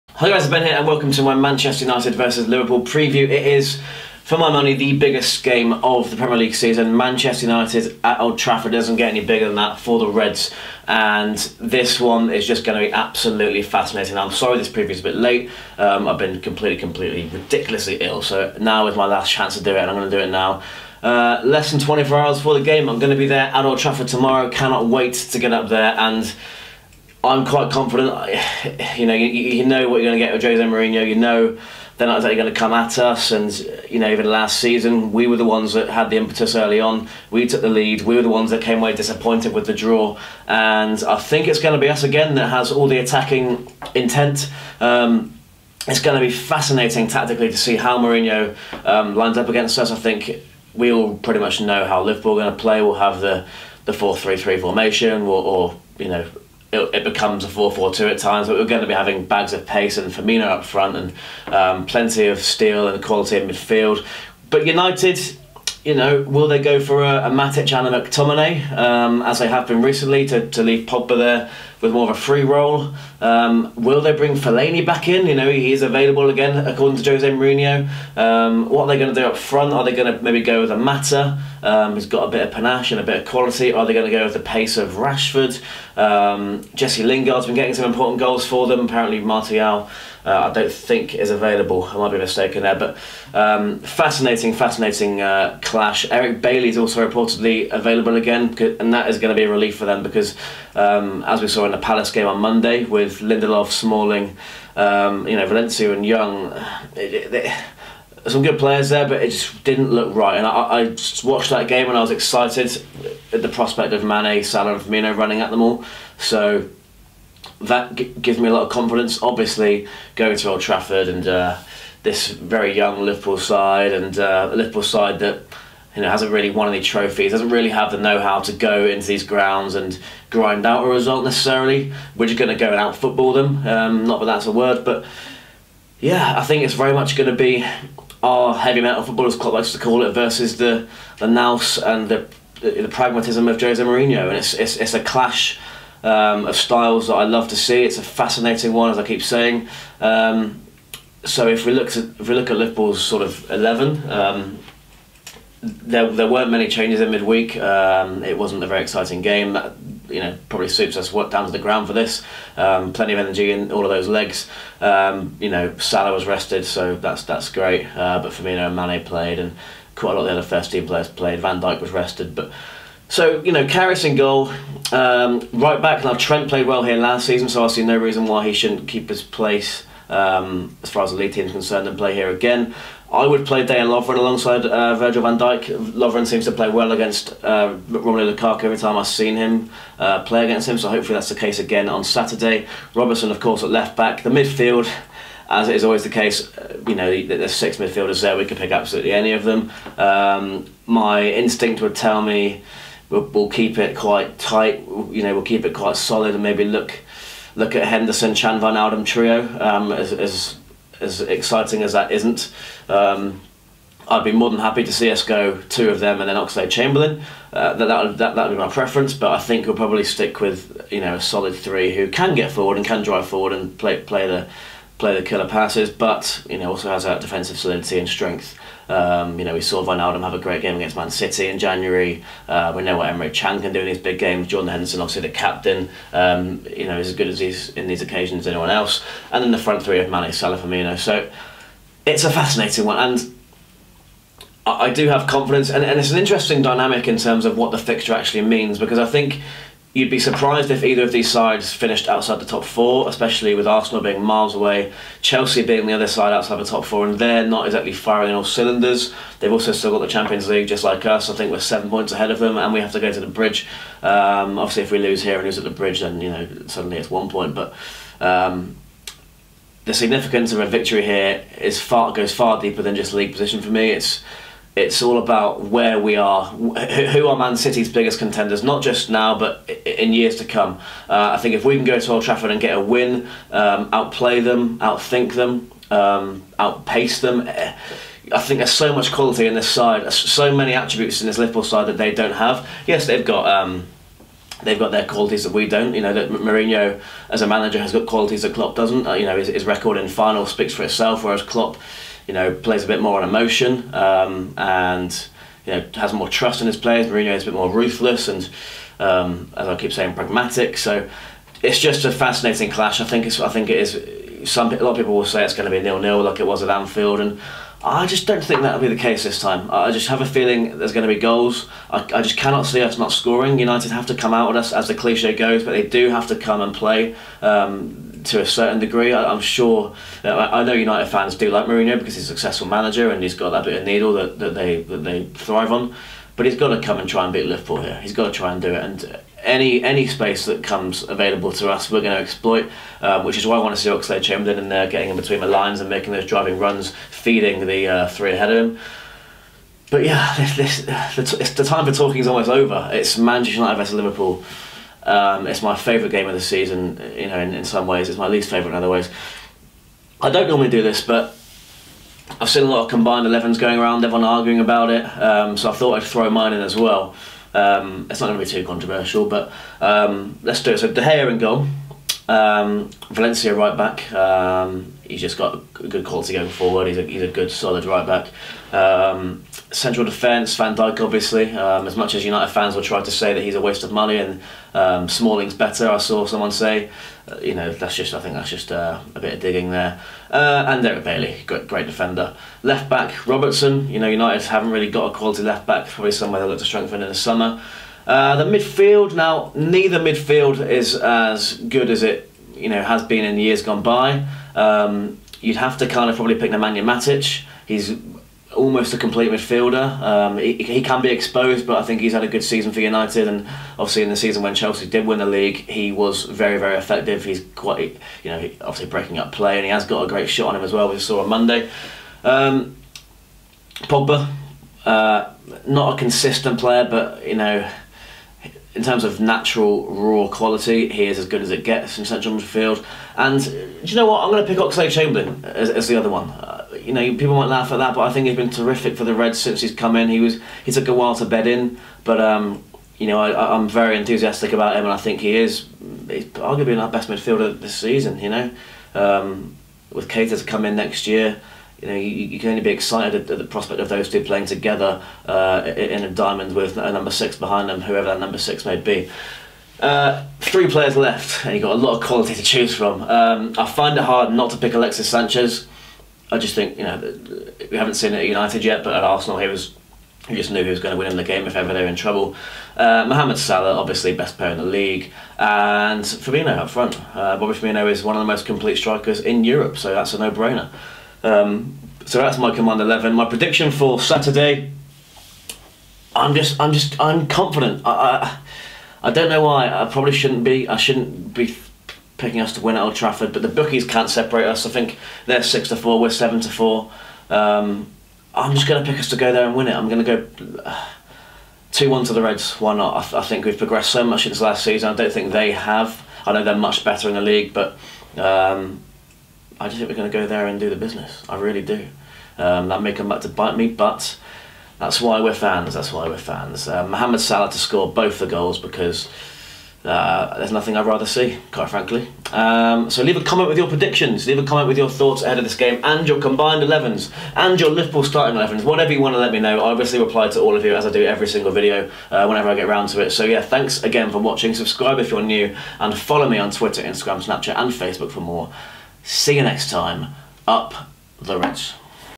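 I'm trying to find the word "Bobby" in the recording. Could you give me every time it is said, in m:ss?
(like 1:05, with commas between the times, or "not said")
7:57.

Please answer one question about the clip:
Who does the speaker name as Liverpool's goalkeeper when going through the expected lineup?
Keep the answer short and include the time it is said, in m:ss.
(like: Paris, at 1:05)
Karius, at 2:53.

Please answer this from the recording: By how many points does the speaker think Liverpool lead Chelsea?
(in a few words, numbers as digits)
7.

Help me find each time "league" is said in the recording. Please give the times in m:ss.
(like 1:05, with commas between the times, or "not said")
0:06, 3:01, 4:20, 4:33, 6:55, 7:54, 8:27.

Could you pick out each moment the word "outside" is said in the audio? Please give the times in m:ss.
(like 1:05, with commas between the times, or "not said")
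4:12, 4:16.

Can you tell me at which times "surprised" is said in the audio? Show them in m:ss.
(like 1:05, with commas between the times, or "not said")
4:10.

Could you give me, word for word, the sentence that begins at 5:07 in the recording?
Mourinho is a bit more ruthless and, um, as I keep saying, pragmatic.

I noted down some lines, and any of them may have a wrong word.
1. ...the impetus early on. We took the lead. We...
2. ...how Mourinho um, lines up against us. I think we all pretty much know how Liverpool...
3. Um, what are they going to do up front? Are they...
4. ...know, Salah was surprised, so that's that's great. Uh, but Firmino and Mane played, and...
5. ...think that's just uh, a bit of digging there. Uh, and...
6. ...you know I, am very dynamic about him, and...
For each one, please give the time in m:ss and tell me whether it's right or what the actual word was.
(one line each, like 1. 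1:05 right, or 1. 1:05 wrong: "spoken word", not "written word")
1. 0:36 right
2. 0:47 right
3. 1:18 right
4. 2:45 wrong: "rested", not "surprised"
5. 6:28 right
6. 7:22 wrong: "enthusiastic", not "dynamic".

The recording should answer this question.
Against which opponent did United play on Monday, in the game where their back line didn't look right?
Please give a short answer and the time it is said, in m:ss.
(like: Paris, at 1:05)
Palace, at 1:41.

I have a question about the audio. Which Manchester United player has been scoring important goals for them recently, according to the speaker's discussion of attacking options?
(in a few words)
Jesse Lingard.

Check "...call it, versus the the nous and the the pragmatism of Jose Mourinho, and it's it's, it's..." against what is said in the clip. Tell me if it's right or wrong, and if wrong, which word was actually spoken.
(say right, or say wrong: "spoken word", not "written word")
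right.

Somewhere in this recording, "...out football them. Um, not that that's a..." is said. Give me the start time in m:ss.
2:12.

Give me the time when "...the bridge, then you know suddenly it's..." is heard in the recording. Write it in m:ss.
4:25.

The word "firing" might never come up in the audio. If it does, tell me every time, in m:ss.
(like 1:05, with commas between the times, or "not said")
4:17.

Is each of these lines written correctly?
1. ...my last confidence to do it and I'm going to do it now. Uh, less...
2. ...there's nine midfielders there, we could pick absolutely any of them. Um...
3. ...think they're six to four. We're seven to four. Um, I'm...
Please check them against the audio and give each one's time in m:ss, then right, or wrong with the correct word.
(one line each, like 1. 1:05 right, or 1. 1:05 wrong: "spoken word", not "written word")
1. 0:18 wrong: "chance", not "confidence"
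2. 3:17 wrong: "six", not "nine"
3. 8:14 right.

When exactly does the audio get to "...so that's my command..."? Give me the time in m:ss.
8:02.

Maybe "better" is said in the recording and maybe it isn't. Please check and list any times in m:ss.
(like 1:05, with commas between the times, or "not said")
6:25, 8:26.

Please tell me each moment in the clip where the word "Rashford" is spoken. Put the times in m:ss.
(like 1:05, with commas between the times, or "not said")
1:24.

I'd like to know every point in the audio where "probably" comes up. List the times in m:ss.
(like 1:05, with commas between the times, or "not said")
2:40, 3:39, 6:35, 6:46, 8:09.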